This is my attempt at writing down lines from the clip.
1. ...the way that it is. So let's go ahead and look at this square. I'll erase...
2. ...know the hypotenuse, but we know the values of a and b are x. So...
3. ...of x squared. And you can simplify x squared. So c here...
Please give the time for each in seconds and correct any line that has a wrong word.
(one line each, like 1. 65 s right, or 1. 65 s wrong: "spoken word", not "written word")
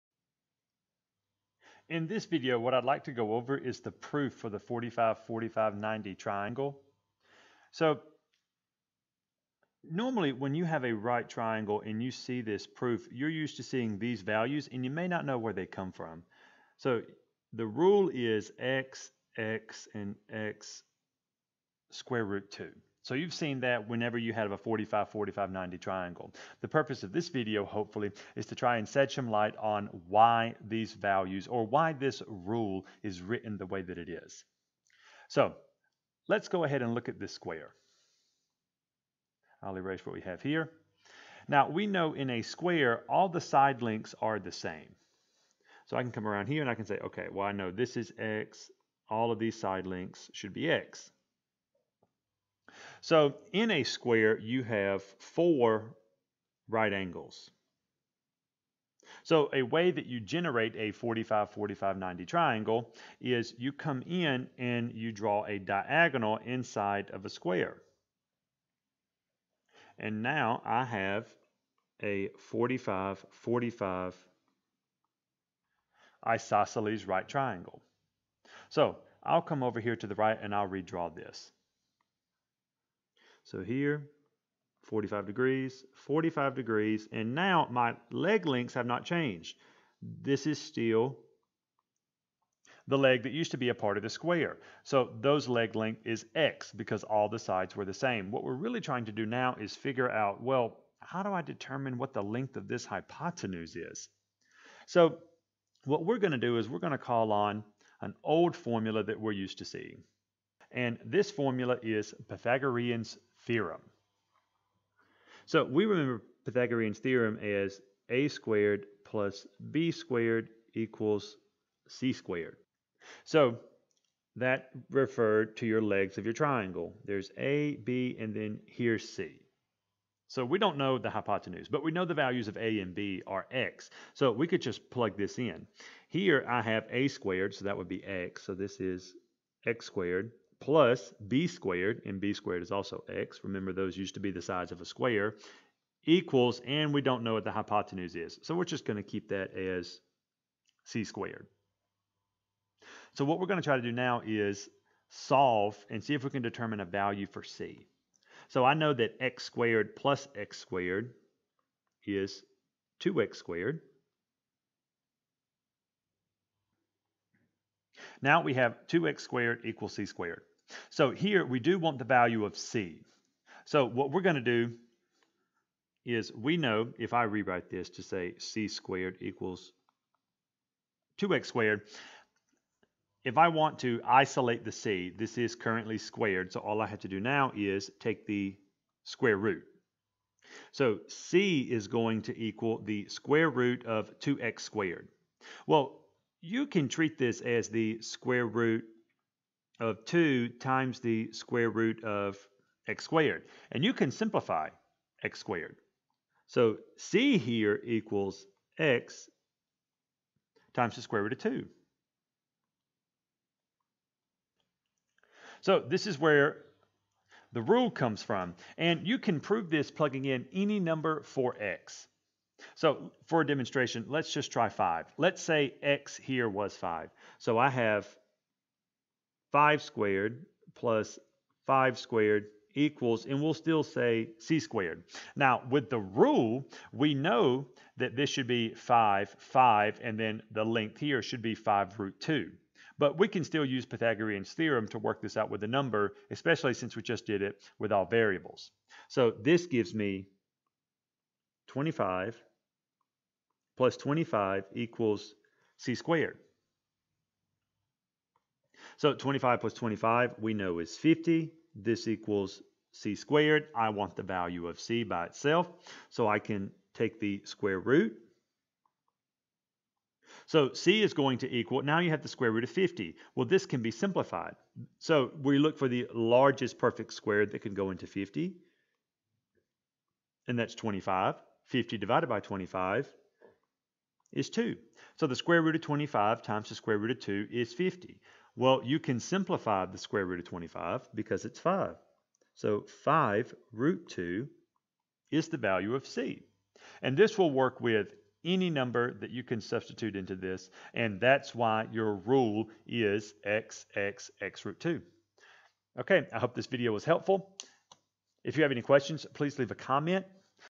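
1. 33 s right
2. 130 s right
3. 202 s right.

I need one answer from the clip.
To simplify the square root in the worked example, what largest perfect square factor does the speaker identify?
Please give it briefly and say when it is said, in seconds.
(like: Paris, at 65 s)
25, at 280 s.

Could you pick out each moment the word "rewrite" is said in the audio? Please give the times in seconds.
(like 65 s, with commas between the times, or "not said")
177 s.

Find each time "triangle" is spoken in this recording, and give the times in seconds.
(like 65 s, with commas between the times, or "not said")
6 s, 11 s, 25 s, 62 s, 77 s, 126 s.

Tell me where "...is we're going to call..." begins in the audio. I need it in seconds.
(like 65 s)
106 s.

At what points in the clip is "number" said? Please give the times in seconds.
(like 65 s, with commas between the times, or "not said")
220 s, 245 s, 298 s.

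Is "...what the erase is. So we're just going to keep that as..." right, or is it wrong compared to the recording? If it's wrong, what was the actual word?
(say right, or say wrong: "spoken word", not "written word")
wrong: "hypotenuse", not "erase".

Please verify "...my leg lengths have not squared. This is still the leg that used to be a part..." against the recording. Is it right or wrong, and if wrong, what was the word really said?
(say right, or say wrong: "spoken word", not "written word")
wrong: "changed", not "squared".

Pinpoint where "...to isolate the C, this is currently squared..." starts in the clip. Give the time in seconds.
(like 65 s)
183 s.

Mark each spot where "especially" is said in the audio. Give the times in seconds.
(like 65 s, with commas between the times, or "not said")
246 s.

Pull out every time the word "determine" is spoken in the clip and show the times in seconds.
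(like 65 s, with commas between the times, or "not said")
101 s, 156 s.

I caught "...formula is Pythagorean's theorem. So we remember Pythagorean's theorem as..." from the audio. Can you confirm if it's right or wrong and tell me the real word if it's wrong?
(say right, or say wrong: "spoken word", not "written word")
right.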